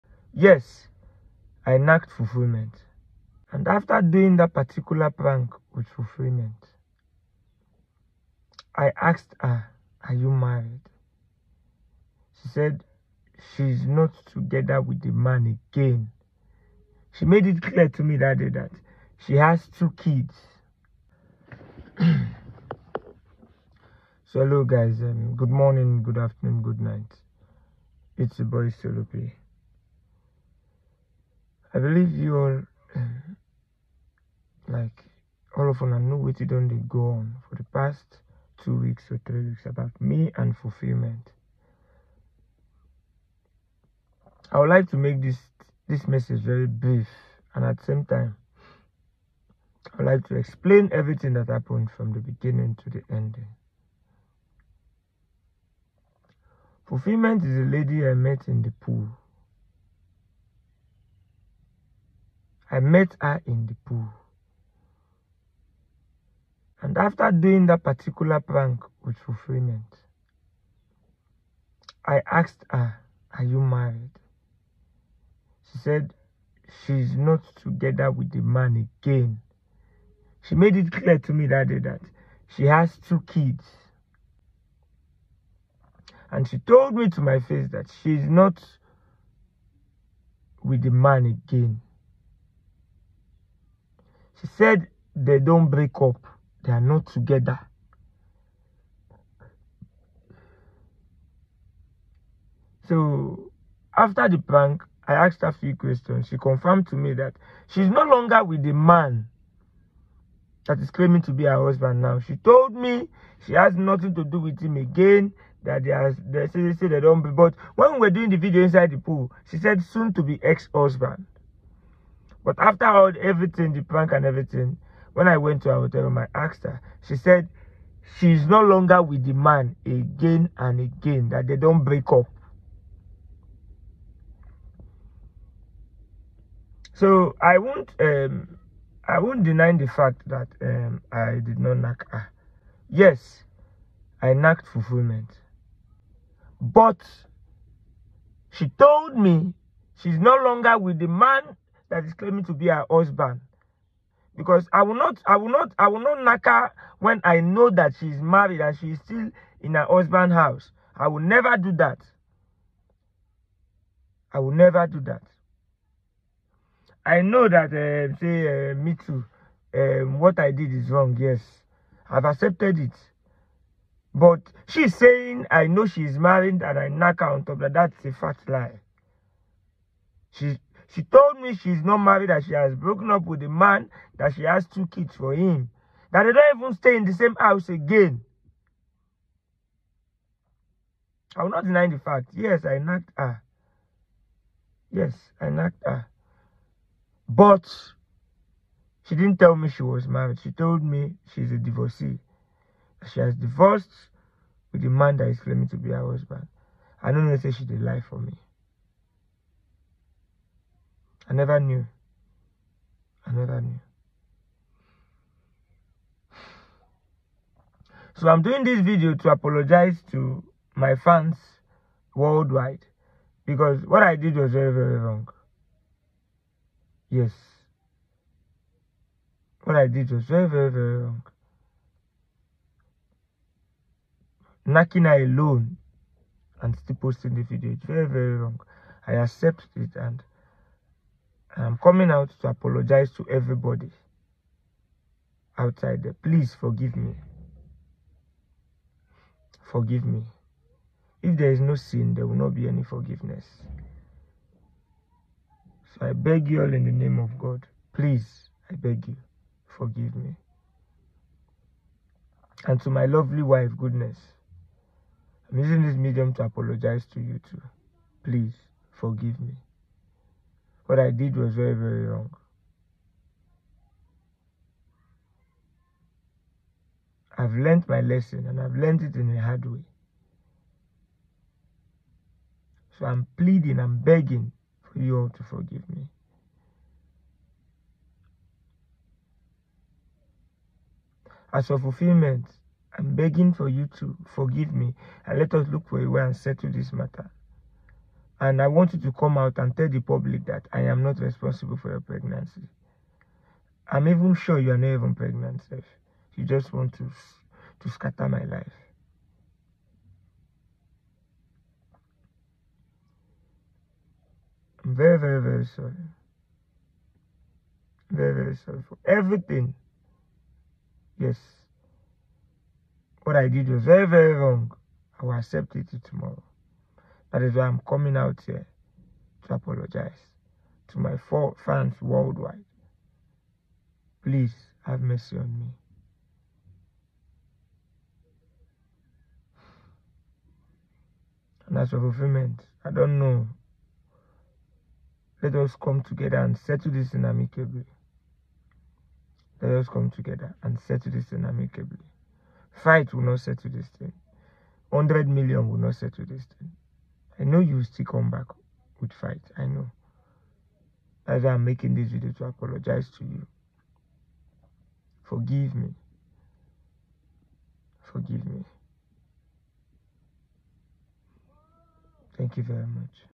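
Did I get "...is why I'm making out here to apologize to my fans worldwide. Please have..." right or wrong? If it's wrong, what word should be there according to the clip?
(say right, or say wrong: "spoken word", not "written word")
wrong: "coming", not "making".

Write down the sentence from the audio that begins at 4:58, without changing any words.
And I wanted to come out and tell the public that I am not responsible for your pregnancy.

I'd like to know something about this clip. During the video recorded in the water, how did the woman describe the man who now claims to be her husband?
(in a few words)
soon to be ex-husband.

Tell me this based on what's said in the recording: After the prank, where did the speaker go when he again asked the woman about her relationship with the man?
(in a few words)
her hotel room.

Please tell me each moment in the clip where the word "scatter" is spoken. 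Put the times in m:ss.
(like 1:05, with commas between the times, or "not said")
5:07.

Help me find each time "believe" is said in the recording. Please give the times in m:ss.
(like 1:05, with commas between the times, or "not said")
0:31.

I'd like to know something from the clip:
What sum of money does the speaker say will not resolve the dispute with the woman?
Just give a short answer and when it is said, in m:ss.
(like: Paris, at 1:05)
100 million, at 5:54.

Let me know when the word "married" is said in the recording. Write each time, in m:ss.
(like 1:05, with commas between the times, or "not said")
0:10, 1:13, 2:38, 2:56, 3:01, 3:20.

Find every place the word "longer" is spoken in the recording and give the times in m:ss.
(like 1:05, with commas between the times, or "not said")
1:48, 2:08, 2:30.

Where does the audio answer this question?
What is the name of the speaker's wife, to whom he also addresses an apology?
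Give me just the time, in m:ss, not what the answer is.
4:23.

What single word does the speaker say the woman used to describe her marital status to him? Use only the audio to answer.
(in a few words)
divorcee.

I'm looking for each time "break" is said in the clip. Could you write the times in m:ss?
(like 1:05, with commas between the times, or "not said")
1:35, 2:11.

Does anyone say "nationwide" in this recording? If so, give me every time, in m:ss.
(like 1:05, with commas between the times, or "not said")
not said.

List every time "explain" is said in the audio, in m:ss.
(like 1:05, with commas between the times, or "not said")
0:50.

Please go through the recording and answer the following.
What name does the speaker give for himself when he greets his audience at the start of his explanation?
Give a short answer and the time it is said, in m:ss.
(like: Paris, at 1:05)
Solope, at 0:28.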